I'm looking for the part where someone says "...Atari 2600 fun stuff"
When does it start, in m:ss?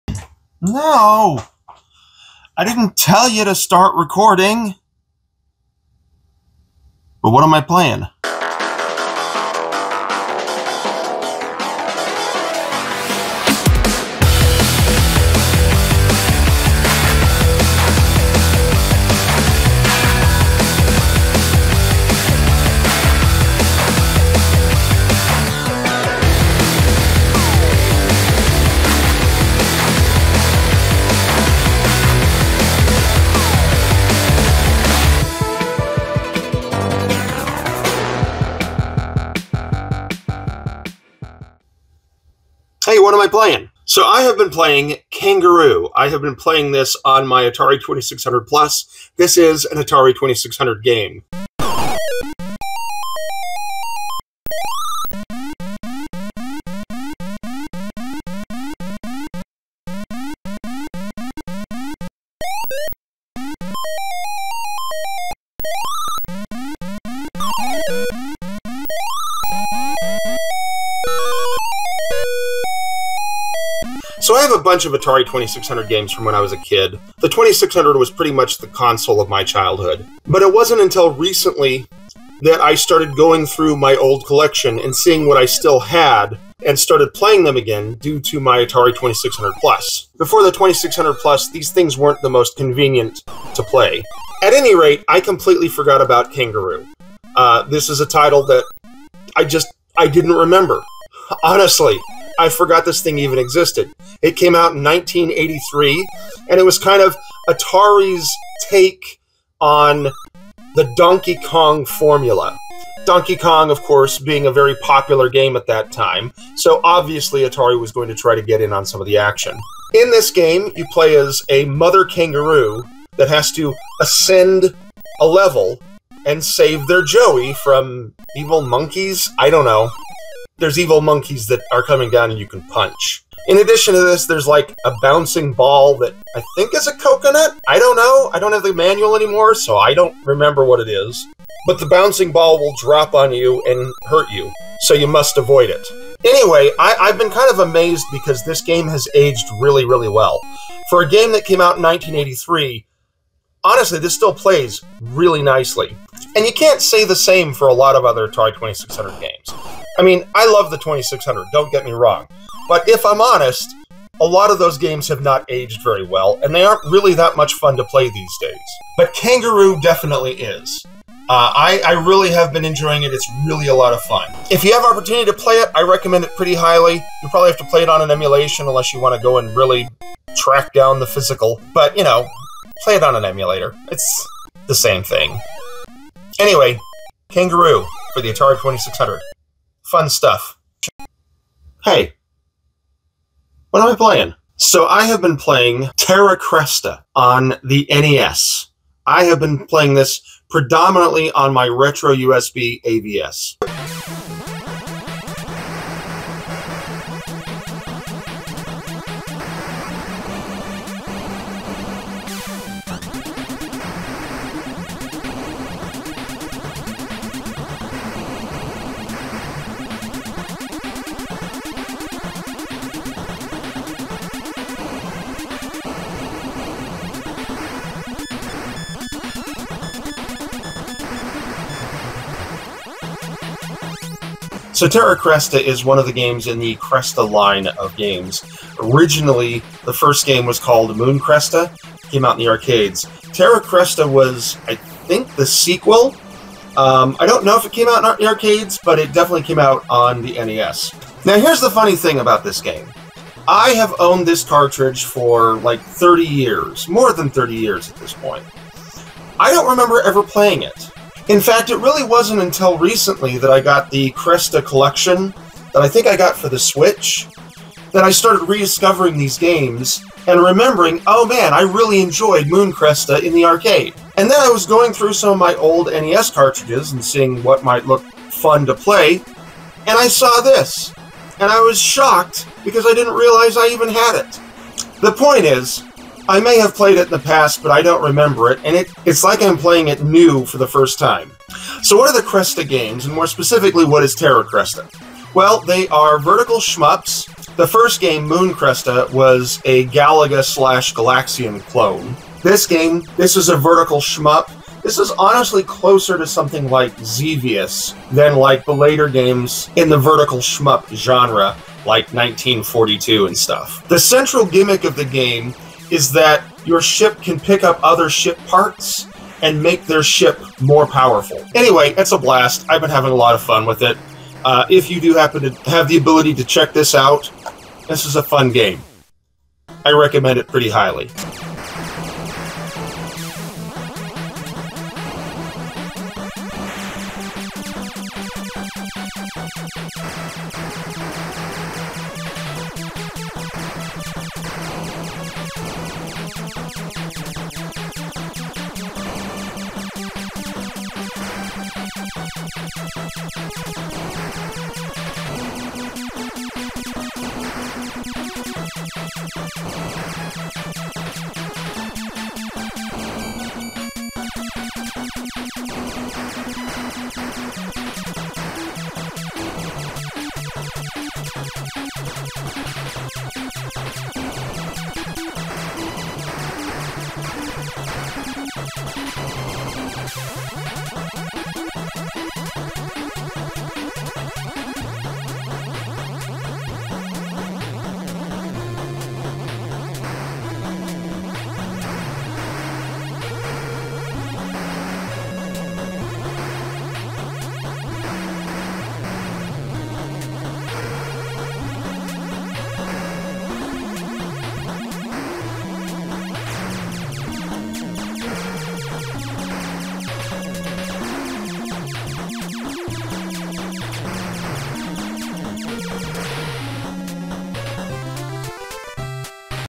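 3:08.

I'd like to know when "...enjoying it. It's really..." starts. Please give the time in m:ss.
2:52.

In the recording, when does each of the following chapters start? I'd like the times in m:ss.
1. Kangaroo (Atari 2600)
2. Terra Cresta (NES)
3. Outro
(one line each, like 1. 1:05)
1. 0:41
2. 3:10
3. 5:31.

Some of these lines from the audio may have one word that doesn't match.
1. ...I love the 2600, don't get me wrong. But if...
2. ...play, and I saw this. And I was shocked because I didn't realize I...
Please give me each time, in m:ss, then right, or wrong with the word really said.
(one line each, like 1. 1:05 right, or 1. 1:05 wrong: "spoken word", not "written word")
1. 2:40 right
2. 4:38 right.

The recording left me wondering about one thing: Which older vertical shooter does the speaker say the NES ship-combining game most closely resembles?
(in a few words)
Xevious.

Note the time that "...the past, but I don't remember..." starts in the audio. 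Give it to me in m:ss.
4:47.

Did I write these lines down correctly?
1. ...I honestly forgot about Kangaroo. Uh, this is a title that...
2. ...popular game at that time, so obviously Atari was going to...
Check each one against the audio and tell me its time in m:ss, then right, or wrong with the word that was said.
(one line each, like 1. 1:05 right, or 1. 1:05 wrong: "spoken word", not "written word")
1. 1:35 wrong: "completely", not "honestly"
2. 1:54 right.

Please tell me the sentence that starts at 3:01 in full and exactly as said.
But, you know, play it on an emulator.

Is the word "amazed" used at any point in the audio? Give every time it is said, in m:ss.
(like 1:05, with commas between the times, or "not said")
2:27.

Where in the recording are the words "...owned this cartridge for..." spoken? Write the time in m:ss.
4:13.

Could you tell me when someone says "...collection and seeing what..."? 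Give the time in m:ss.
1:24.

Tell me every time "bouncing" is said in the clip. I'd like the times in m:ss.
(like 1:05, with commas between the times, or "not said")
2:15, 2:21.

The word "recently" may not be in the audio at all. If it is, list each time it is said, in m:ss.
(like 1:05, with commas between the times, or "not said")
1:21, 4:22.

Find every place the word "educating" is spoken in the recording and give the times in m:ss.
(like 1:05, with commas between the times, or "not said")
not said.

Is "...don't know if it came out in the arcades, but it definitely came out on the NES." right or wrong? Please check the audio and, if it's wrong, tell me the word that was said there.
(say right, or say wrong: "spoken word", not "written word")
right.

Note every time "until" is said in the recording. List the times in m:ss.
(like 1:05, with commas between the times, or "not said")
1:20, 4:22.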